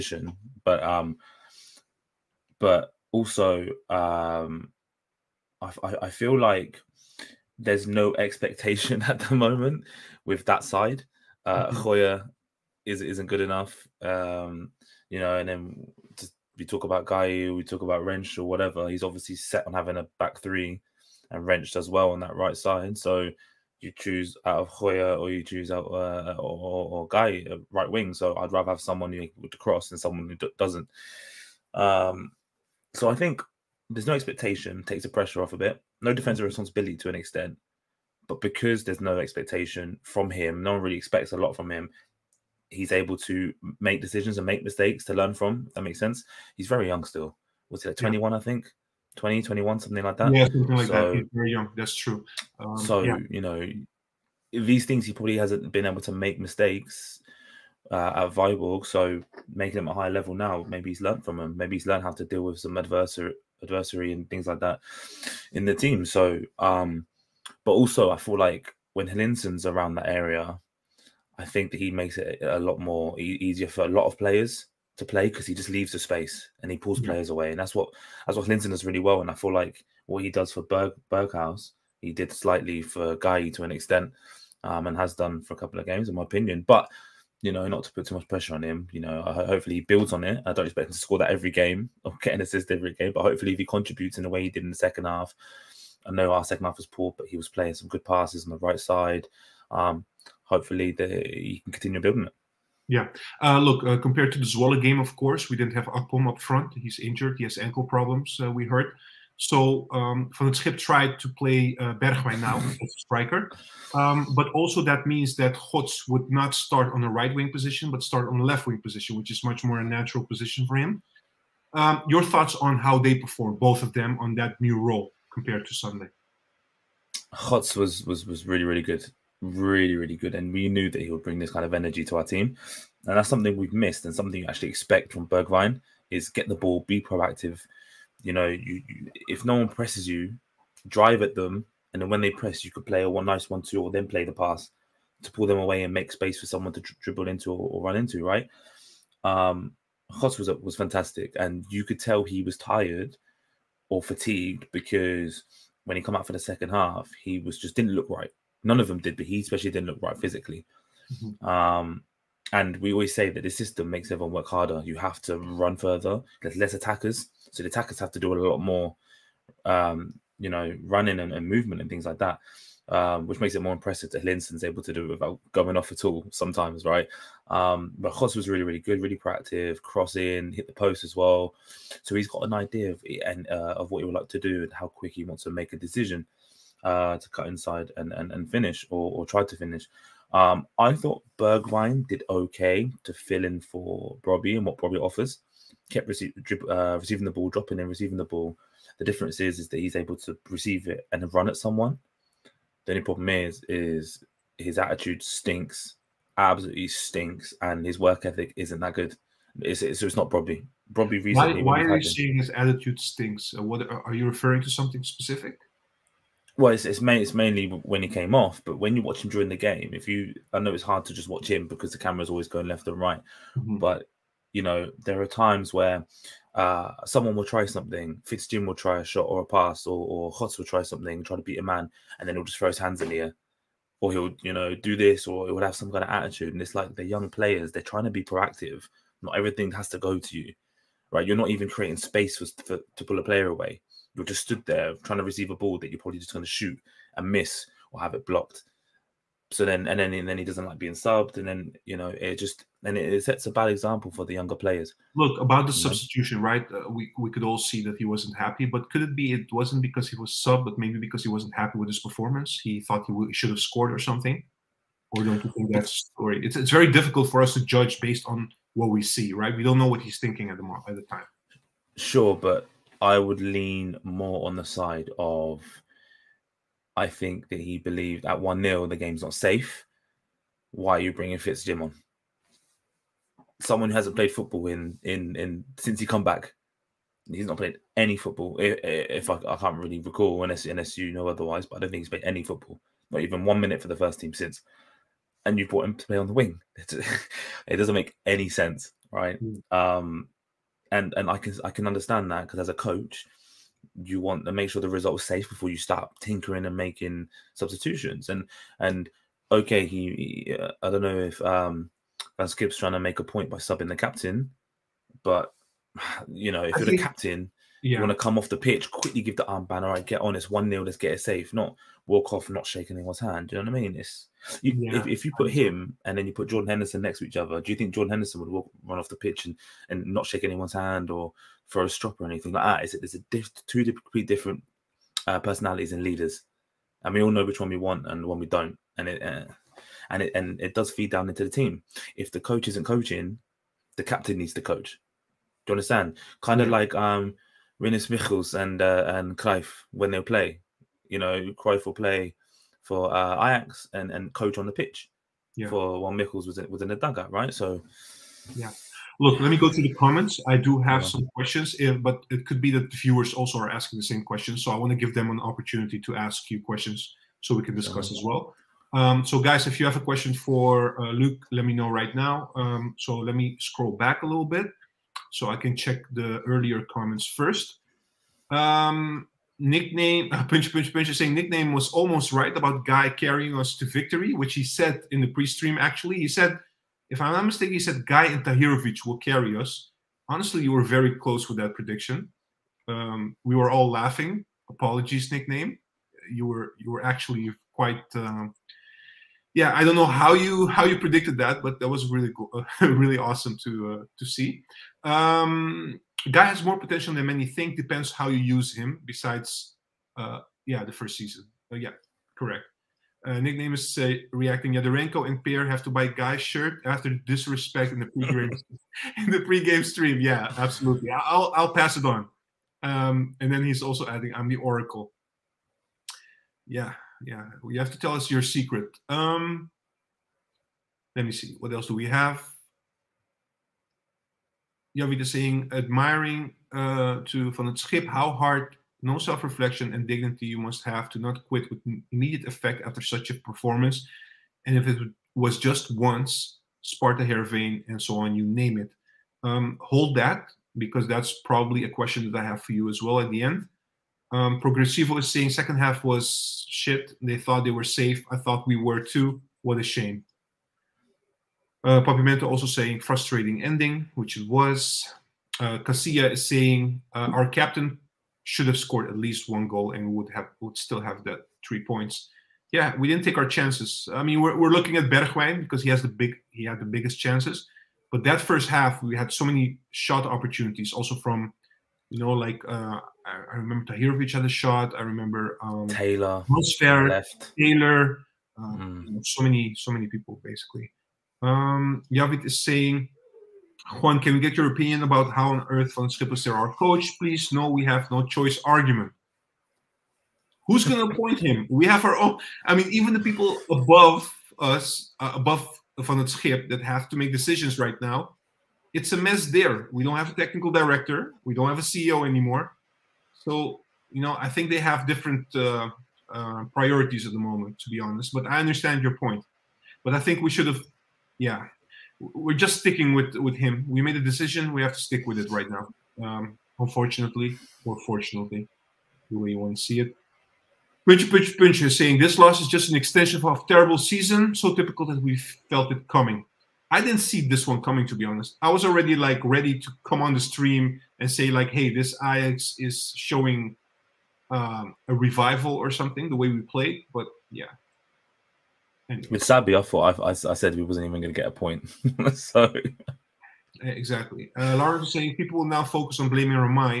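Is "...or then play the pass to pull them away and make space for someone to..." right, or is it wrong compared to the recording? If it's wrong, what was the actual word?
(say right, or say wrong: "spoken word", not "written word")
right.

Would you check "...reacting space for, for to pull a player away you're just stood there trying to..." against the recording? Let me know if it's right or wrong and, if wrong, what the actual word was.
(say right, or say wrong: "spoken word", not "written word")
wrong: "creating", not "reacting".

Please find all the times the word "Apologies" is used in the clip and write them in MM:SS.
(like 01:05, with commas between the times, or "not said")
06:34.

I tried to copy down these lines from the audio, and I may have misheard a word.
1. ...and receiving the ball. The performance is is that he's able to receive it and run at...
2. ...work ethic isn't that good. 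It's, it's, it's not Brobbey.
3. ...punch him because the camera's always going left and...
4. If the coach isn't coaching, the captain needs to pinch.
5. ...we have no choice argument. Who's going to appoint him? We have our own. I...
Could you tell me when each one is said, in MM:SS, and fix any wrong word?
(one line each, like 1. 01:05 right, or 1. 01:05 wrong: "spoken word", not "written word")
1. 03:17 wrong: "difference", not "performance"
2. 03:27 right
3. 03:41 wrong: "watch", not "punch"
4. 05:42 wrong: "coach", not "pinch"
5. 08:17 right.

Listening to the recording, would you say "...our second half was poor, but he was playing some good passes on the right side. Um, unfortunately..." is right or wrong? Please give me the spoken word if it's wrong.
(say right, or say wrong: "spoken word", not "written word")
wrong: "hopefully", not "unfortunately".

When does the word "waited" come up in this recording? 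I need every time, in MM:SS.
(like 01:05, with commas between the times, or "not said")
not said.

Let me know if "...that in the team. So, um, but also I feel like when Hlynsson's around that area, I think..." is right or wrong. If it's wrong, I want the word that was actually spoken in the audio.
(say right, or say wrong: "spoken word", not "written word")
right.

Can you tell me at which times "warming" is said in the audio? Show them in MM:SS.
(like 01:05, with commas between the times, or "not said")
not said.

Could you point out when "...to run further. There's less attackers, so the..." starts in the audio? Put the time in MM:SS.
02:45.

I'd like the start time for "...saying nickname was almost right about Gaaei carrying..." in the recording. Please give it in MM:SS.
06:21.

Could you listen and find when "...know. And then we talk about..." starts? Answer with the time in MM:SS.
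00:15.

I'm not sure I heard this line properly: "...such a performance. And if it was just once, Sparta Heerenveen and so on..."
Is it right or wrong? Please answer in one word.
right.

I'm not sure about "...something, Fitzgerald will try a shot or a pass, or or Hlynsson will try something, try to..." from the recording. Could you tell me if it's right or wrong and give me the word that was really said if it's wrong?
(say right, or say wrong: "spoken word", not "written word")
wrong: "Godts", not "Hlynsson".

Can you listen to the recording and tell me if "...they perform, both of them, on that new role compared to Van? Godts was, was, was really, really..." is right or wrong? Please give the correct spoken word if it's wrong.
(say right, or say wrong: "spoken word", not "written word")
wrong: "Sunday", not "Van".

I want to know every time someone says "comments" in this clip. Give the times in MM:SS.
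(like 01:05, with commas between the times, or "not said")
05:59, 06:16.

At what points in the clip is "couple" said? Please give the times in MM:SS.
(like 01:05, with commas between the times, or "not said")
01:25.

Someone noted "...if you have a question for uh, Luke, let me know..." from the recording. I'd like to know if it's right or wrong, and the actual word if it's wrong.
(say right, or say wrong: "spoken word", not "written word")
right.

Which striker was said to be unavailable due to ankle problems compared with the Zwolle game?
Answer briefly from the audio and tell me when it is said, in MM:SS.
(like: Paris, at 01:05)
Akpom, at 01:45.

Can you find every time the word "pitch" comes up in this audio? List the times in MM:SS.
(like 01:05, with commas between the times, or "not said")
05:18, 05:29, 05:54.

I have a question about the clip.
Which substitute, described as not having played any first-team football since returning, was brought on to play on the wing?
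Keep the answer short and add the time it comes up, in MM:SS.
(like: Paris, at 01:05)
Fitz-Jim, at 04:41.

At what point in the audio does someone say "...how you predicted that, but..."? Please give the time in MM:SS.
06:40.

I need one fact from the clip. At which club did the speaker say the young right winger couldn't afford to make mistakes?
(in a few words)
Viborg.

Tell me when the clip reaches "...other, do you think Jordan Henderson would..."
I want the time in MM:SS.
05:27.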